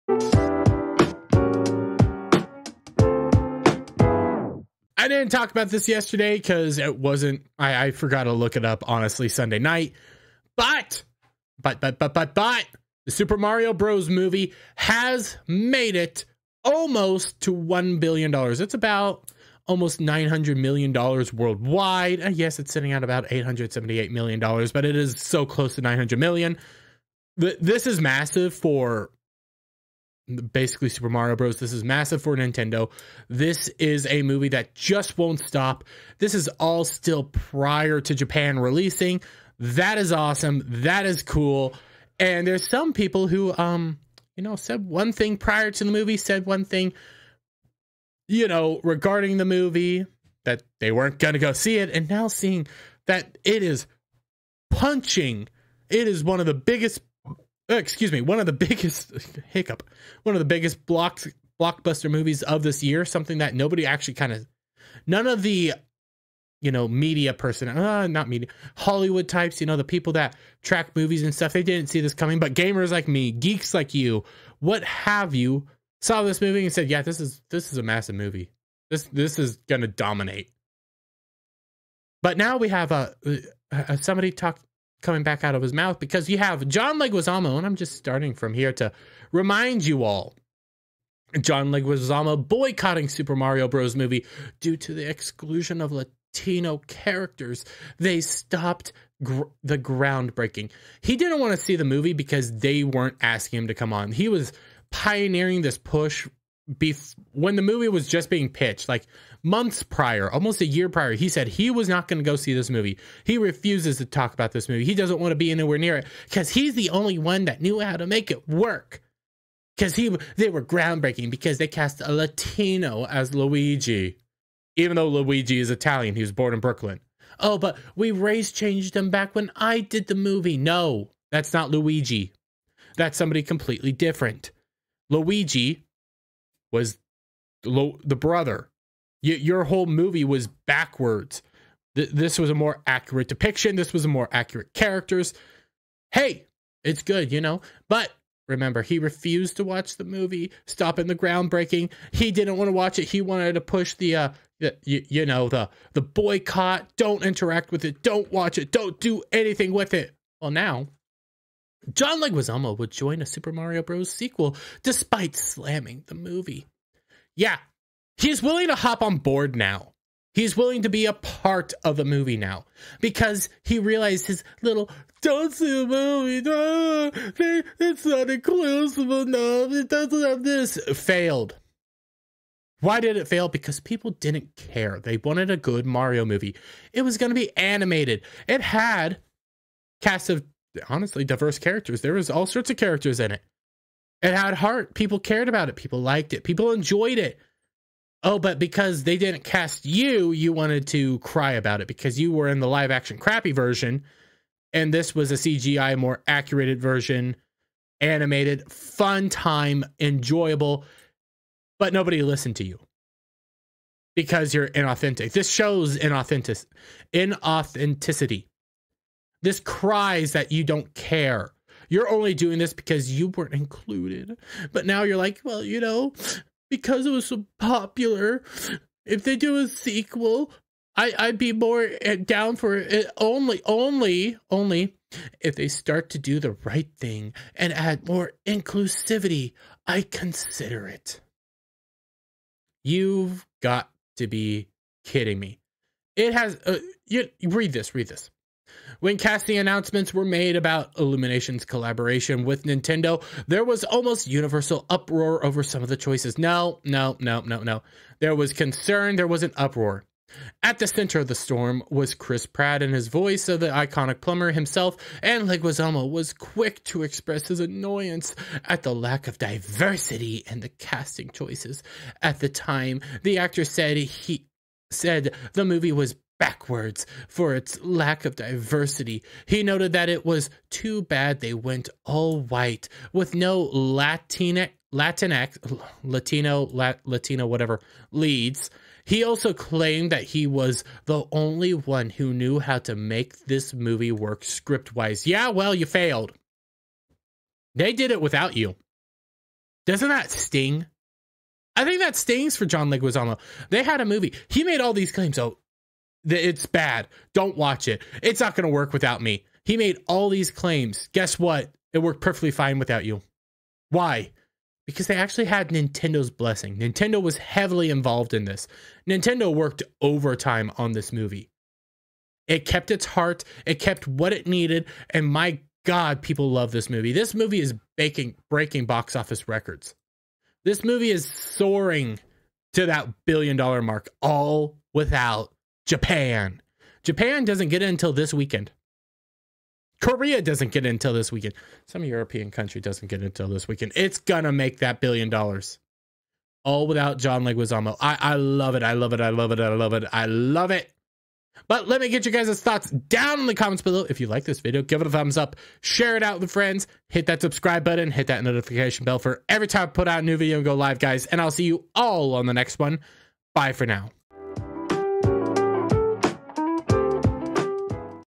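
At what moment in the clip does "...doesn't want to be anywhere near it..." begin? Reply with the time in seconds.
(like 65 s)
114 s.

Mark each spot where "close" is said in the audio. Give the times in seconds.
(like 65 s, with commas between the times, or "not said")
25 s.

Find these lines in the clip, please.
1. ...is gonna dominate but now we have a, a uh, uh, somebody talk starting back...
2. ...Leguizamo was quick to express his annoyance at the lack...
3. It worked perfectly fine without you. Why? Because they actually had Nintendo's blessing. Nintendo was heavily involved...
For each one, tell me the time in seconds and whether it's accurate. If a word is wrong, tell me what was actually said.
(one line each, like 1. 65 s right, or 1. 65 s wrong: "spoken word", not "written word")
1. 79 s wrong: "coming", not "starting"
2. 265 s right
3. 311 s right.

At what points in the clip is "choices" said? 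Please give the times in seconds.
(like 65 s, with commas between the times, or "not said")
255 s, 271 s.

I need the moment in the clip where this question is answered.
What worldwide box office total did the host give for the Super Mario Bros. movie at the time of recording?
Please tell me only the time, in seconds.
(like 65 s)
23 s.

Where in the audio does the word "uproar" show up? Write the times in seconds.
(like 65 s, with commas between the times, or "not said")
254 s, 259 s.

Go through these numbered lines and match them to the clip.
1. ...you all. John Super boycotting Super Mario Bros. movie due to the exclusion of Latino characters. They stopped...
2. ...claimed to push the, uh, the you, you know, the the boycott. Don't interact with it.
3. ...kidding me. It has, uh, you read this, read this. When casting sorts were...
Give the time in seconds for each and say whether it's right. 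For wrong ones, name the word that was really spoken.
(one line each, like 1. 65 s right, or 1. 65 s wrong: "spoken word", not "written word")
1. 89 s wrong: "Leguizamo", not "Super"
2. 153 s wrong: "wanted", not "claimed"
3. 245 s wrong: "announcements", not "sorts".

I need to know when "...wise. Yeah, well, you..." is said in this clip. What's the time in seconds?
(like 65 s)
294 s.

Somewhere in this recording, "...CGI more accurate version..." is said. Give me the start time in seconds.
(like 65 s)
205 s.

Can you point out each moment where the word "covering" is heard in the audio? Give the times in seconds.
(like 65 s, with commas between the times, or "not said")
not said.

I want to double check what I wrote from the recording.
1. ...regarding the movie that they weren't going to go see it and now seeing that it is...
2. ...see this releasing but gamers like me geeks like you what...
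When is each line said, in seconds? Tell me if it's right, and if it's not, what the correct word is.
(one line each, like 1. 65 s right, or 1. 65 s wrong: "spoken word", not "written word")
1. 48 s right
2. 71 s wrong: "coming", not "releasing".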